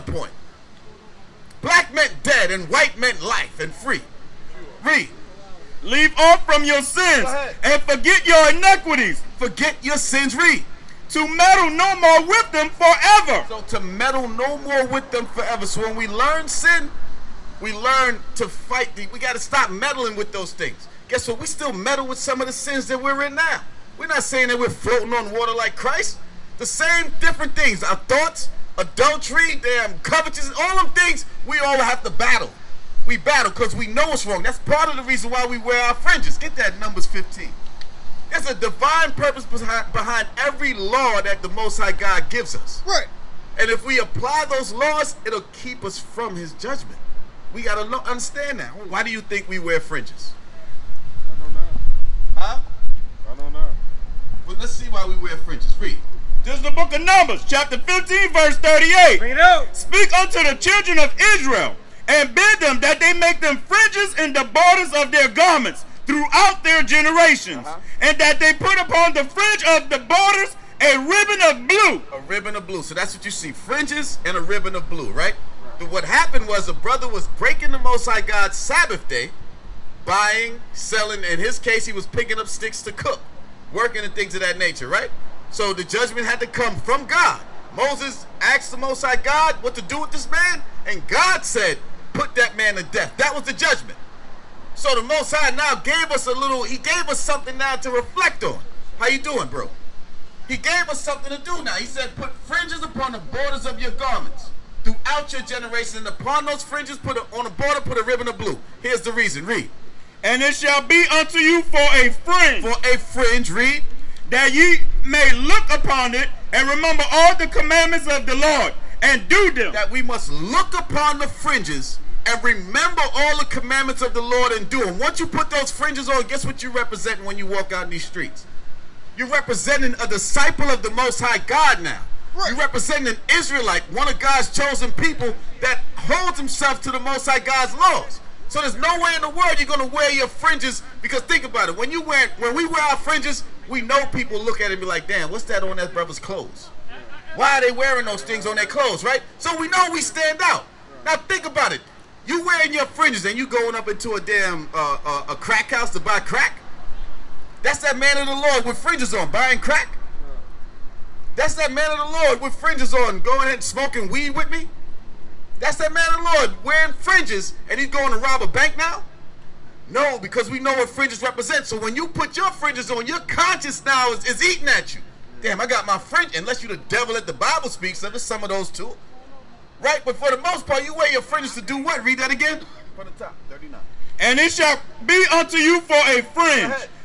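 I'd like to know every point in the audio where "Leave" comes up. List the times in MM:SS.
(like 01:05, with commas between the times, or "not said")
00:05.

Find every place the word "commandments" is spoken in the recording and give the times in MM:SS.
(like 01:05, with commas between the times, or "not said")
01:57, 02:03.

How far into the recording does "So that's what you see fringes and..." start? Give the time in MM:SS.
01:12.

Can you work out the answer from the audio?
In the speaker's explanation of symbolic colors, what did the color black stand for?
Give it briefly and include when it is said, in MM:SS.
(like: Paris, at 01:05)
dead, at 00:01.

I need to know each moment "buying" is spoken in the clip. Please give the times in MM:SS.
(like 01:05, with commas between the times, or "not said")
01:20, 02:39.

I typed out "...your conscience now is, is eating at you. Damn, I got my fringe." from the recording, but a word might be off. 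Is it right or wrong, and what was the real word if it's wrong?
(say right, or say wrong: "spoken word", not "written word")
right.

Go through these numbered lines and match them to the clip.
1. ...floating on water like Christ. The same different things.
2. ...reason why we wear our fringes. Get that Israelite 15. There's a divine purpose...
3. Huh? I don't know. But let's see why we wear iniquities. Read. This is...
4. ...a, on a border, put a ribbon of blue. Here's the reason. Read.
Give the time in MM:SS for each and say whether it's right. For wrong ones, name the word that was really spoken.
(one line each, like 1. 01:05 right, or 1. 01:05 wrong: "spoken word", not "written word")
1. 00:24 right
2. 00:35 wrong: "Numbers", not "Israelite"
3. 00:52 wrong: "fringes", not "iniquities"
4. 01:47 right.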